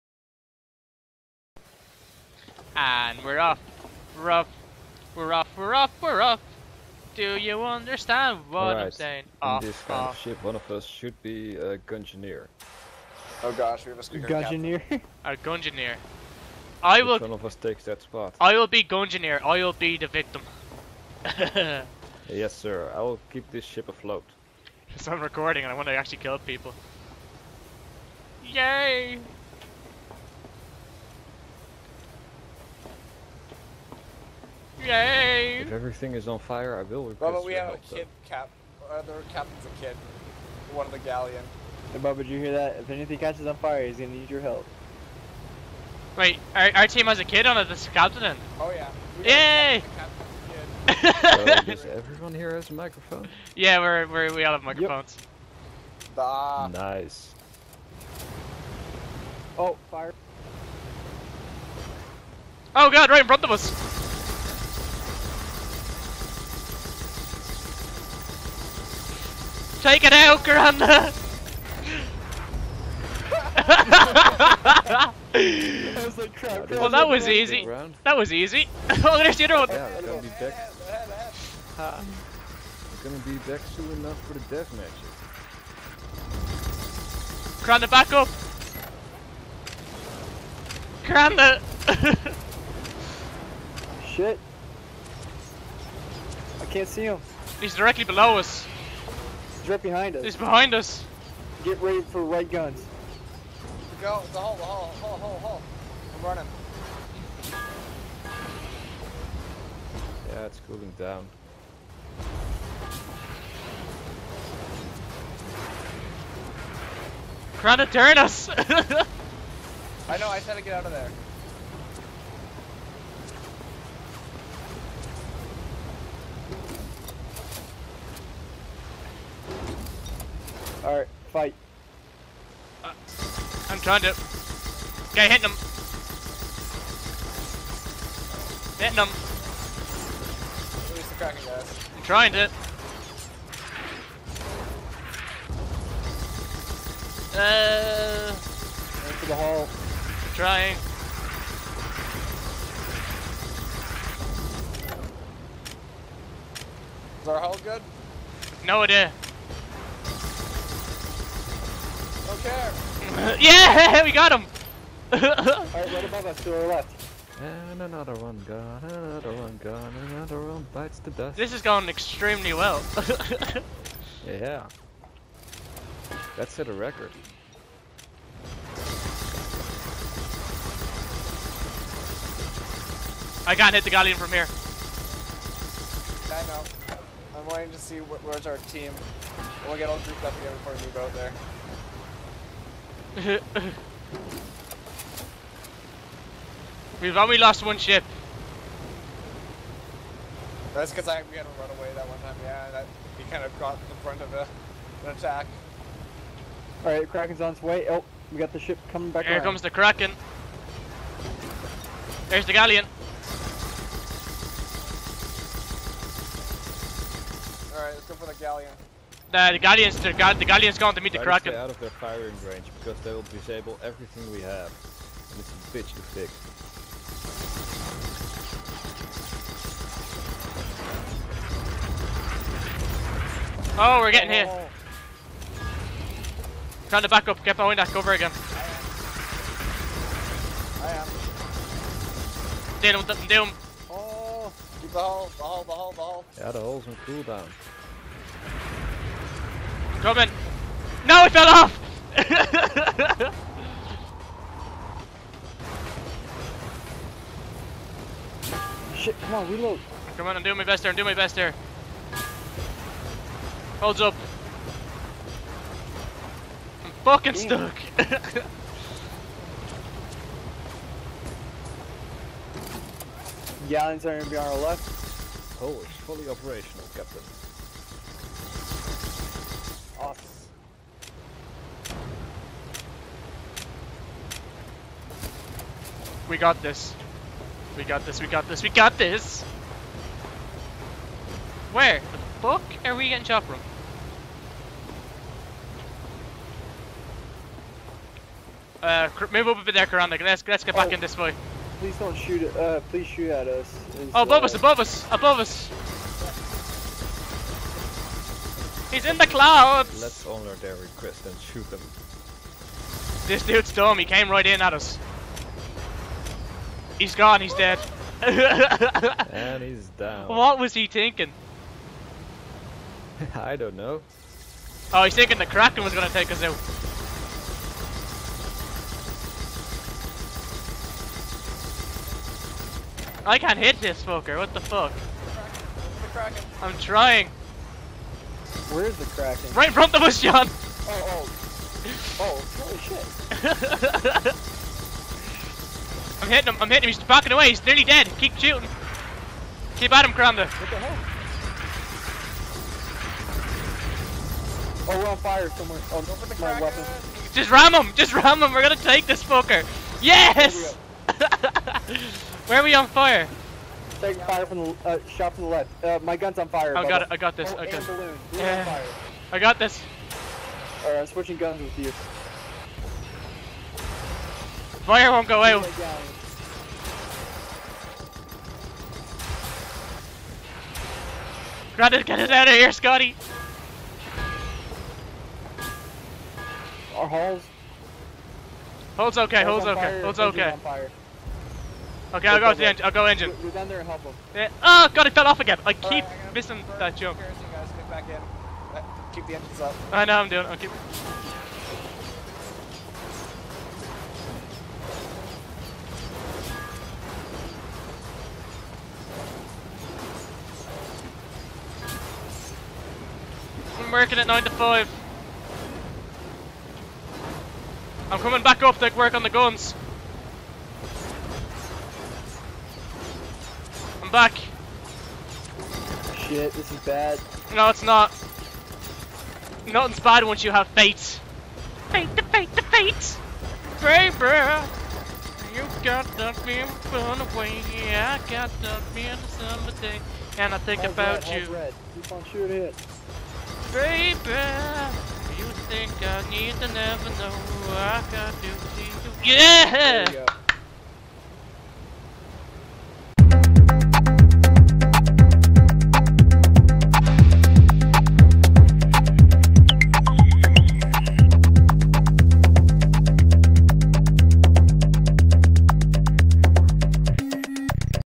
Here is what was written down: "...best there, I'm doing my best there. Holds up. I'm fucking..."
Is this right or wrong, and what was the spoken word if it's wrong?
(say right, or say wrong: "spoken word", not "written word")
right.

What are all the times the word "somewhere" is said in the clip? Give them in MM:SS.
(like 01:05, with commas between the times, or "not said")
05:55.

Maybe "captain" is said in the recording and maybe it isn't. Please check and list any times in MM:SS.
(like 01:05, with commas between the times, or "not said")
00:39, 00:47, 04:36.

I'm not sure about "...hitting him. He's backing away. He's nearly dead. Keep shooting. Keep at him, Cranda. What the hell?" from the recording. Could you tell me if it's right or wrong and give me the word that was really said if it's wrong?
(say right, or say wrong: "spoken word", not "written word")
right.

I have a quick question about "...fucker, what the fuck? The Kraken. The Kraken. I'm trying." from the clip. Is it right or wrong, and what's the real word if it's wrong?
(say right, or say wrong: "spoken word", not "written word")
right.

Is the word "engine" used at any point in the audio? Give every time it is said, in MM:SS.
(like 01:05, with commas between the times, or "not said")
06:33, 06:39.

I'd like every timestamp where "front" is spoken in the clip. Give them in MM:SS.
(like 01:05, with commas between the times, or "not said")
01:03, 03:24, 05:39.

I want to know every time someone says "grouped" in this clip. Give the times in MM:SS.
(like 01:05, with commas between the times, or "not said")
03:10.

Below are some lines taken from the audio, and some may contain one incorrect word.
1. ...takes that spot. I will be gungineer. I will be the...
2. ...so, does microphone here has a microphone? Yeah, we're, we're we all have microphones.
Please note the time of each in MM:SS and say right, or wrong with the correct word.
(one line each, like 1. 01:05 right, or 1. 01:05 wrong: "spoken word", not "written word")
1. 00:17 right
2. 00:51 wrong: "everyone", not "microphone".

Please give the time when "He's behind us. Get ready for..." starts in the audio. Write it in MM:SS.
01:40.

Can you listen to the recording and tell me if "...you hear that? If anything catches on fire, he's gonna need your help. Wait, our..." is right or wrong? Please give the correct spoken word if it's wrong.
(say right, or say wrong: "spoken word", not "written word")
right.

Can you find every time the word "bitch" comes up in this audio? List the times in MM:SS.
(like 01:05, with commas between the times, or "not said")
03:45.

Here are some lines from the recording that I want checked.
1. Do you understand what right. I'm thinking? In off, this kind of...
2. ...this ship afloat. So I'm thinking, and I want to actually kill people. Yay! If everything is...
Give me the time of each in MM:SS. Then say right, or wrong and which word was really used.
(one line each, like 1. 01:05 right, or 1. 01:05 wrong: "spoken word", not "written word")
1. 00:07 wrong: "saying", not "thinking"
2. 00:23 wrong: "recording", not "thinking".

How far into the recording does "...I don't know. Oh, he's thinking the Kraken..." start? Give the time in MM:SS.
05:23.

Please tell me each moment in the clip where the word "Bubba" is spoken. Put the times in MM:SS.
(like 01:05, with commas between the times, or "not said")
00:37, 00:41.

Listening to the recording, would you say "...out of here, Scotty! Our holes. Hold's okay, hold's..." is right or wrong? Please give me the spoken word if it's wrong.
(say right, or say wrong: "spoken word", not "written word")
right.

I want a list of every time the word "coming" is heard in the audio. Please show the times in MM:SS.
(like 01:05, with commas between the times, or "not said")
03:28, 04:10, 06:58.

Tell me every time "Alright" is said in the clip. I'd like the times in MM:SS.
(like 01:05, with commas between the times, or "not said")
02:10, 02:45, 03:26, 03:37, 06:10.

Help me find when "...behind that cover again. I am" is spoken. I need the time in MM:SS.
03:57.